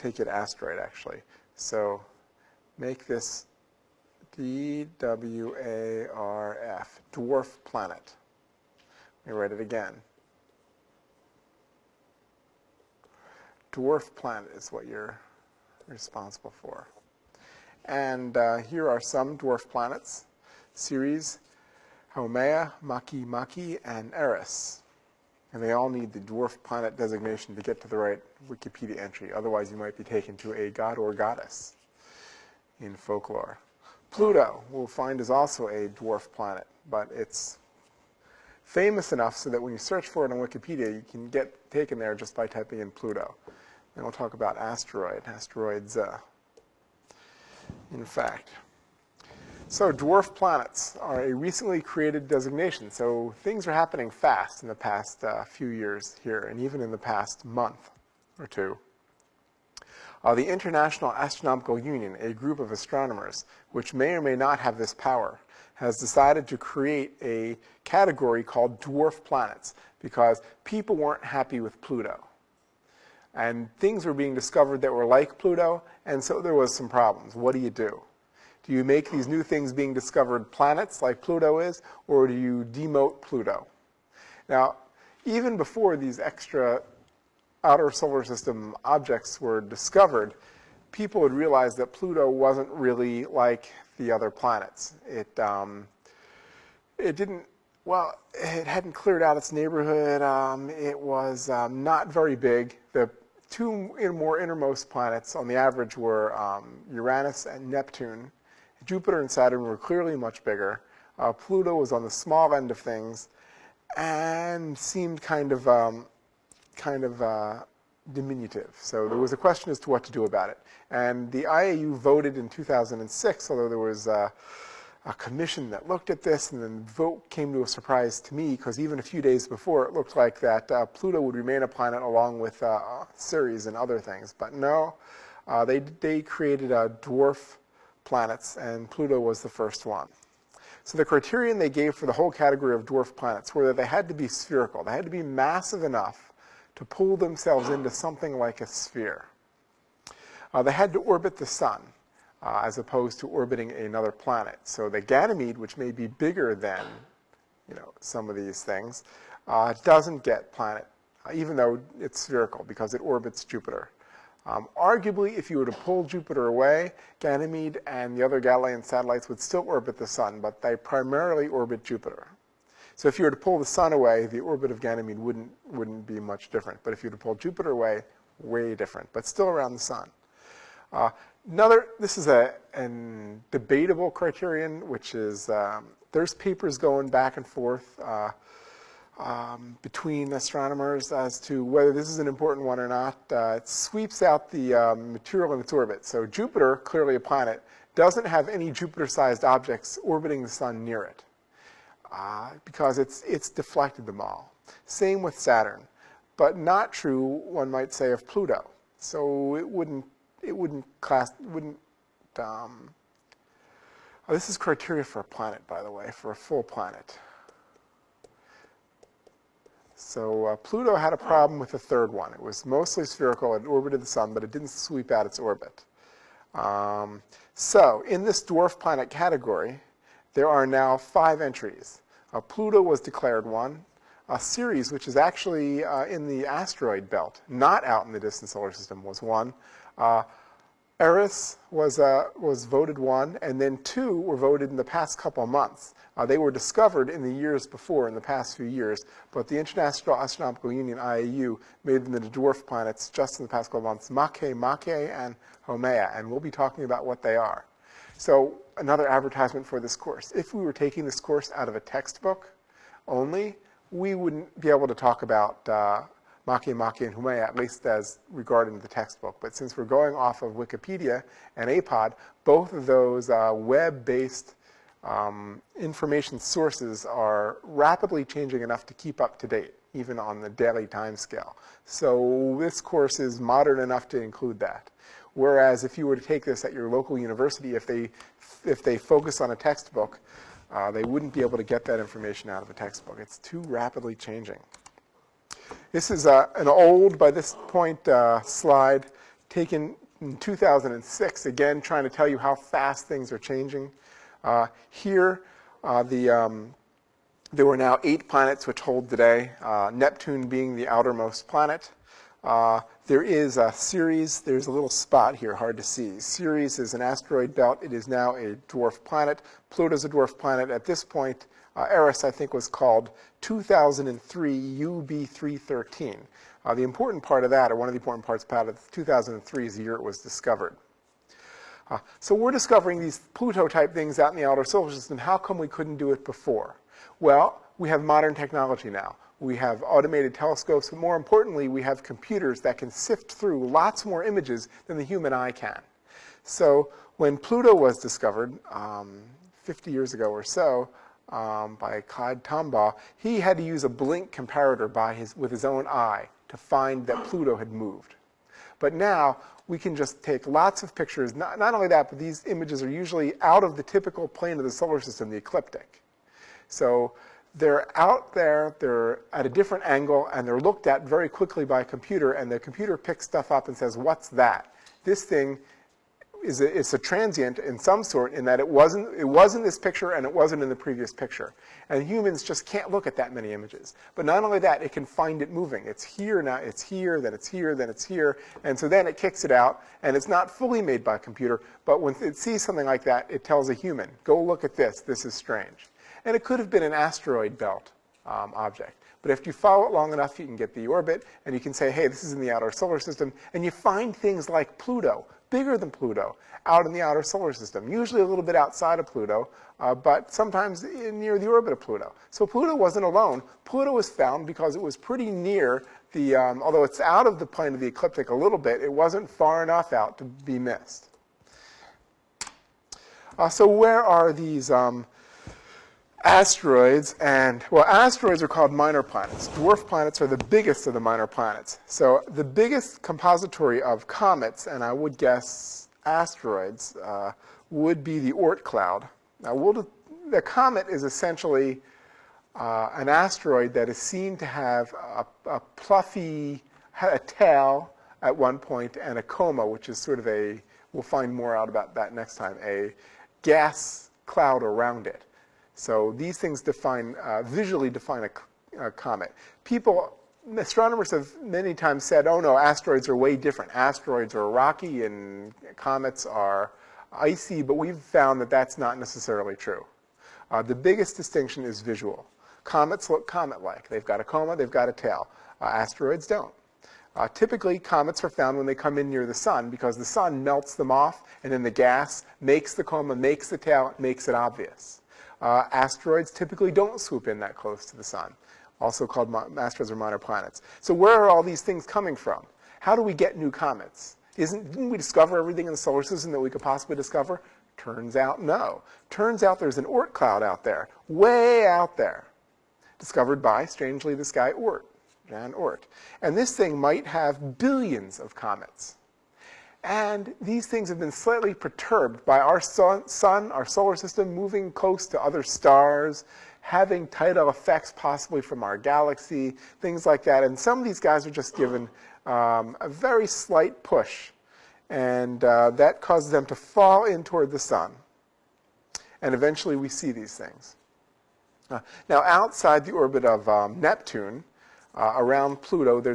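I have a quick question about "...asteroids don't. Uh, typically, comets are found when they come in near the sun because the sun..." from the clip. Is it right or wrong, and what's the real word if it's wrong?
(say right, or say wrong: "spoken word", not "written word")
right.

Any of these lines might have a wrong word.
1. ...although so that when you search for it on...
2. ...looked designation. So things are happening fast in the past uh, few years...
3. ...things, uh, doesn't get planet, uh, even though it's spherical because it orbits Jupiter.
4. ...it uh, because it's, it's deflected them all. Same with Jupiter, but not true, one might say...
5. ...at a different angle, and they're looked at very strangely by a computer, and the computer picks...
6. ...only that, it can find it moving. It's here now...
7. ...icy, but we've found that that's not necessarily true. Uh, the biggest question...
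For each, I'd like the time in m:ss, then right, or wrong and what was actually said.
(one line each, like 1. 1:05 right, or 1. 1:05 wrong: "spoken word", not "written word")
1. 0:39 wrong: "enough", not "although"
2. 0:51 wrong: "created", not "looked"
3. 2:38 right
4. 3:21 wrong: "Saturn", not "Jupiter"
5. 6:09 wrong: "quickly", not "strangely"
6. 6:24 right
7. 7:47 wrong: "distinction", not "question".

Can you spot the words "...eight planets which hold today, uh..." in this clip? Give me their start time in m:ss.
5:08.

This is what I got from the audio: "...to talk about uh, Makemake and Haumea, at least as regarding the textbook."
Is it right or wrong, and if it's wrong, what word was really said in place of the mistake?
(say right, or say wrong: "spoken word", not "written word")
right.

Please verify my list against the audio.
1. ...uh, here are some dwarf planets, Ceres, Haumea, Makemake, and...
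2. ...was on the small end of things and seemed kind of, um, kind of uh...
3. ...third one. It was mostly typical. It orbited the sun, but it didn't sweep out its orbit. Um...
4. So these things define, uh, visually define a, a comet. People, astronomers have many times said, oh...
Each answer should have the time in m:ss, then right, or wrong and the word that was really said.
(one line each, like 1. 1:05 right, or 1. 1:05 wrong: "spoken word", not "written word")
1. 0:18 right
2. 1:51 right
3. 3:41 wrong: "spherical", not "typical"
4. 7:35 right.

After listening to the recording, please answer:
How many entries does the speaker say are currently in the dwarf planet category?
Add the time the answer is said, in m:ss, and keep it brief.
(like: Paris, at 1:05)
5, at 3:50.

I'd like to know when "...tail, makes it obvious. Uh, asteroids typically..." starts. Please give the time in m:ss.
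8:03.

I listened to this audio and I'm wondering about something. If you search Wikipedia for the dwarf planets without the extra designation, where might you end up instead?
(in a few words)
A god or goddess in folklore.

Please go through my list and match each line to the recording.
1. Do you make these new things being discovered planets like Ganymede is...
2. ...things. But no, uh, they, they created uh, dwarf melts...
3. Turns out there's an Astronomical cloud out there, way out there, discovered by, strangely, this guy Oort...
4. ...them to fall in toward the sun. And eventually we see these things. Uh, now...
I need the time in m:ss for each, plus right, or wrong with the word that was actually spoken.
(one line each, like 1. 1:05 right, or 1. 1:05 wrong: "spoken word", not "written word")
1. 1:18 wrong: "Pluto", not "Ganymede"
2. 2:13 wrong: "planets", not "melts"
3. 8:19 wrong: "Oort", not "Astronomical"
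4. 8:46 right.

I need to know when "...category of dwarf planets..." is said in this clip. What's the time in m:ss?
2:22.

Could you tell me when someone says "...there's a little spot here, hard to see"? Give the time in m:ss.
5:14.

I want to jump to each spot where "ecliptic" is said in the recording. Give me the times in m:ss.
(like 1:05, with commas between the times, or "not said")
6:05, 6:57.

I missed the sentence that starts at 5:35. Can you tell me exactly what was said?
How come we couldn't do it before?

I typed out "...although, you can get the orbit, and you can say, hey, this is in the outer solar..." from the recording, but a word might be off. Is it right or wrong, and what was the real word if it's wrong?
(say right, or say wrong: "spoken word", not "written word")
wrong: "enough", not "although".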